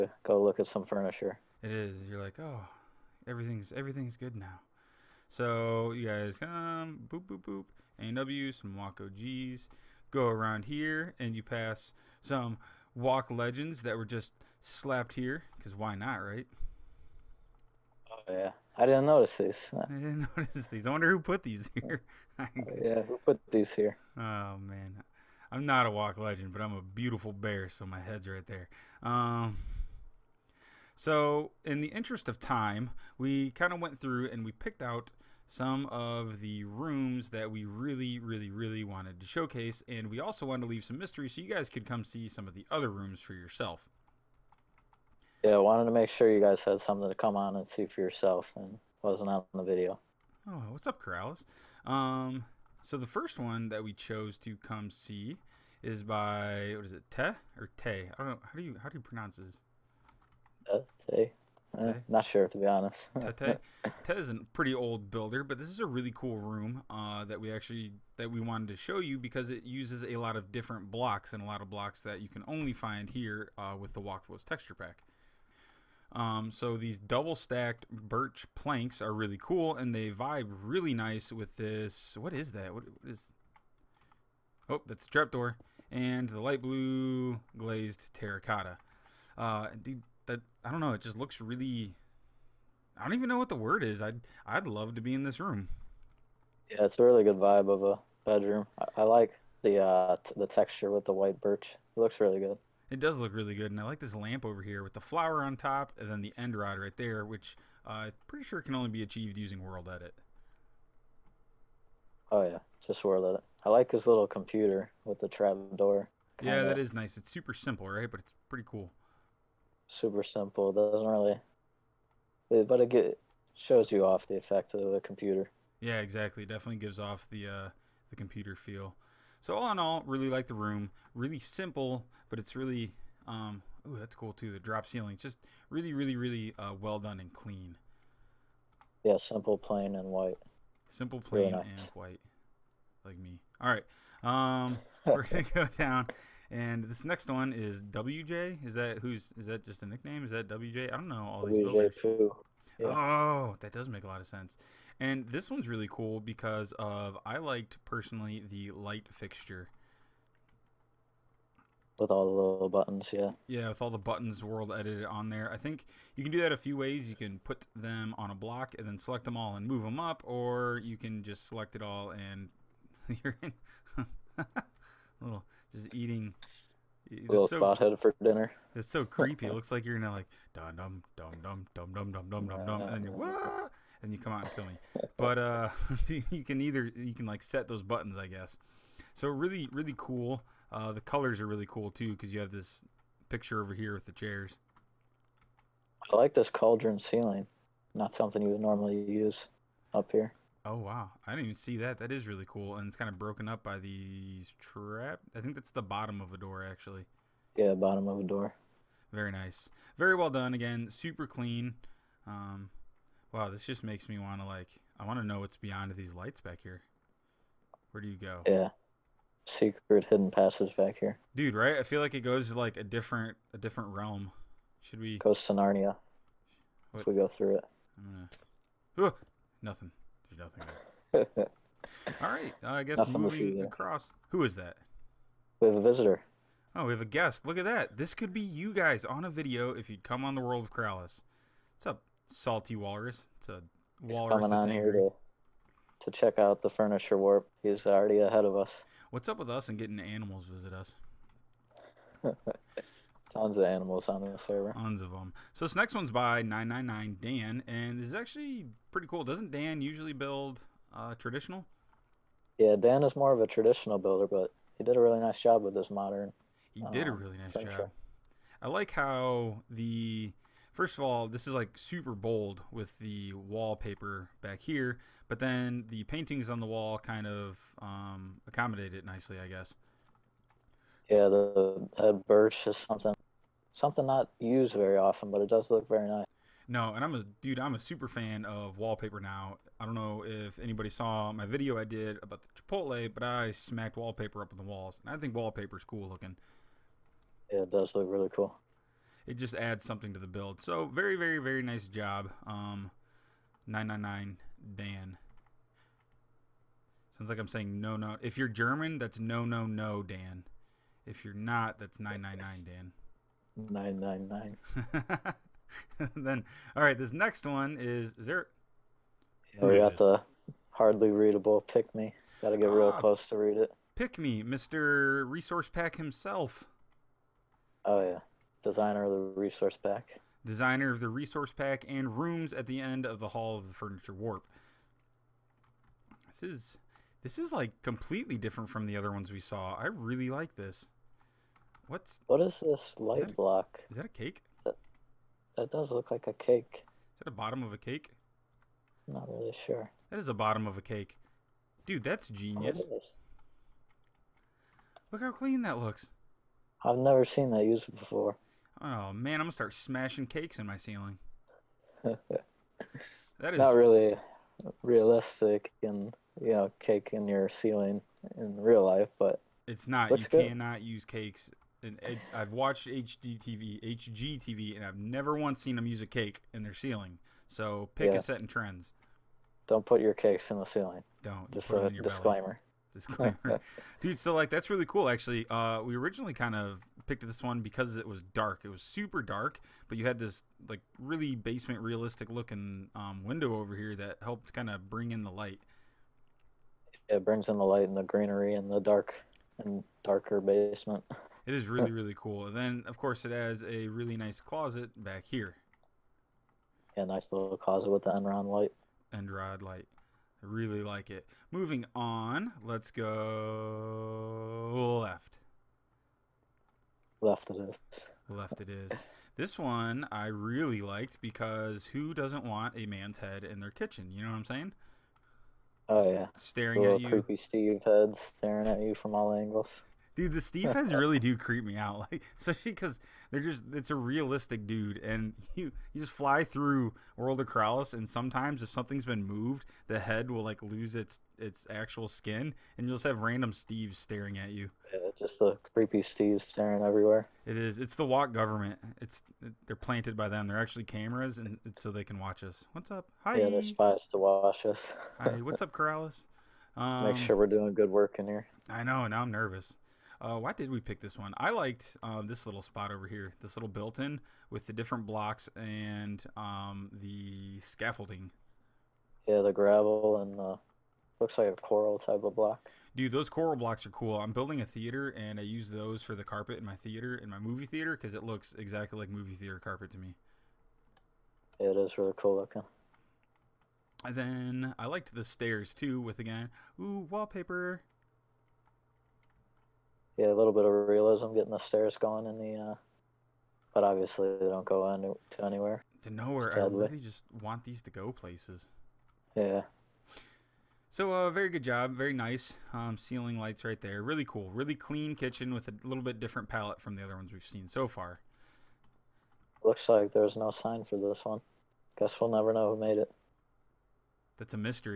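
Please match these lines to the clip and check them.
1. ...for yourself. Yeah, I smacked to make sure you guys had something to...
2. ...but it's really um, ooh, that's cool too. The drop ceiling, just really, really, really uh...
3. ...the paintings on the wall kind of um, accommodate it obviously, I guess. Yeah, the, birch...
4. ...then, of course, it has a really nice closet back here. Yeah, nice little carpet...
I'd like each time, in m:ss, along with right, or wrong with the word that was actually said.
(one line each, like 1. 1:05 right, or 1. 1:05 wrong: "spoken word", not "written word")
1. 0:43 wrong: "wanted", not "smacked"
2. 2:12 right
3. 4:35 wrong: "nicely", not "obviously"
4. 6:42 wrong: "closet", not "carpet".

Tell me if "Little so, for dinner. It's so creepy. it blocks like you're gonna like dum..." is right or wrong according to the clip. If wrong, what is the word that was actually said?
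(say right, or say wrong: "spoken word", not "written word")
wrong: "looks", not "blocks".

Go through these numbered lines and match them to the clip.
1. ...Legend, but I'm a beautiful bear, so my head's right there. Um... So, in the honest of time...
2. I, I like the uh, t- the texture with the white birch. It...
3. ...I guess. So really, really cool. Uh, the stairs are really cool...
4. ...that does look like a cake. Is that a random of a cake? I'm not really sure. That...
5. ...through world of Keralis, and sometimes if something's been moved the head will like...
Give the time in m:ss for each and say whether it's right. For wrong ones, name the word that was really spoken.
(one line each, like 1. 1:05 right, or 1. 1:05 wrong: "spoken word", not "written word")
1. 0:26 wrong: "interest", not "honest"
2. 1:38 right
3. 3:08 wrong: "colors", not "stairs"
4. 5:45 wrong: "bottom", not "random"
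5. 7:16 right.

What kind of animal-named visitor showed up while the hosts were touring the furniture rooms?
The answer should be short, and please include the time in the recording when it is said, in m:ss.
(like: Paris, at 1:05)
salty walrus, at 4:02.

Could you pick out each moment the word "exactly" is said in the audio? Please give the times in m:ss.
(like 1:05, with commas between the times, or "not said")
2:06, 7:58.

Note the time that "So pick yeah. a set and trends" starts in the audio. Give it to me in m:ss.
6:17.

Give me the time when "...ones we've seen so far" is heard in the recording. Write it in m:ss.
8:27.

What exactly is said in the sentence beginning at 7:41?
I liked uh, this little spot over here, this little built-in with the different blocks and um, the scaffolding.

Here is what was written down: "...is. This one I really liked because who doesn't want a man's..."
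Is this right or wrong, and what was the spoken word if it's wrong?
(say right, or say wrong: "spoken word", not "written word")
right.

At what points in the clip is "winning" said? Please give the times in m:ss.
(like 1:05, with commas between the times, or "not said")
not said.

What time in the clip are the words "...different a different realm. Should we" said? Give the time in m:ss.
3:42.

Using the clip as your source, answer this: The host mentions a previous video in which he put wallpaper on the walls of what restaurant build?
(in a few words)
Chipotle.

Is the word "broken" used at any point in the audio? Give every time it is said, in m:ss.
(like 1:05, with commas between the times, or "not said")
3:23.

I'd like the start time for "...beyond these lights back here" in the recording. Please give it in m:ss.
3:35.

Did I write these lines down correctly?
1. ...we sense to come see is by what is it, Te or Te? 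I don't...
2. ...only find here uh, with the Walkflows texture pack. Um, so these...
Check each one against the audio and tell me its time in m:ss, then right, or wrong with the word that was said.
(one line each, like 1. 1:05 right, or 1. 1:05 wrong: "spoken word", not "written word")
1. 0:53 wrong: "chose", not "sense"
2. 1:12 right.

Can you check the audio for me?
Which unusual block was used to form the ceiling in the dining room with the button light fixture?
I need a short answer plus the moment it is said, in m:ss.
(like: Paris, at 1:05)
cauldron, at 3:16.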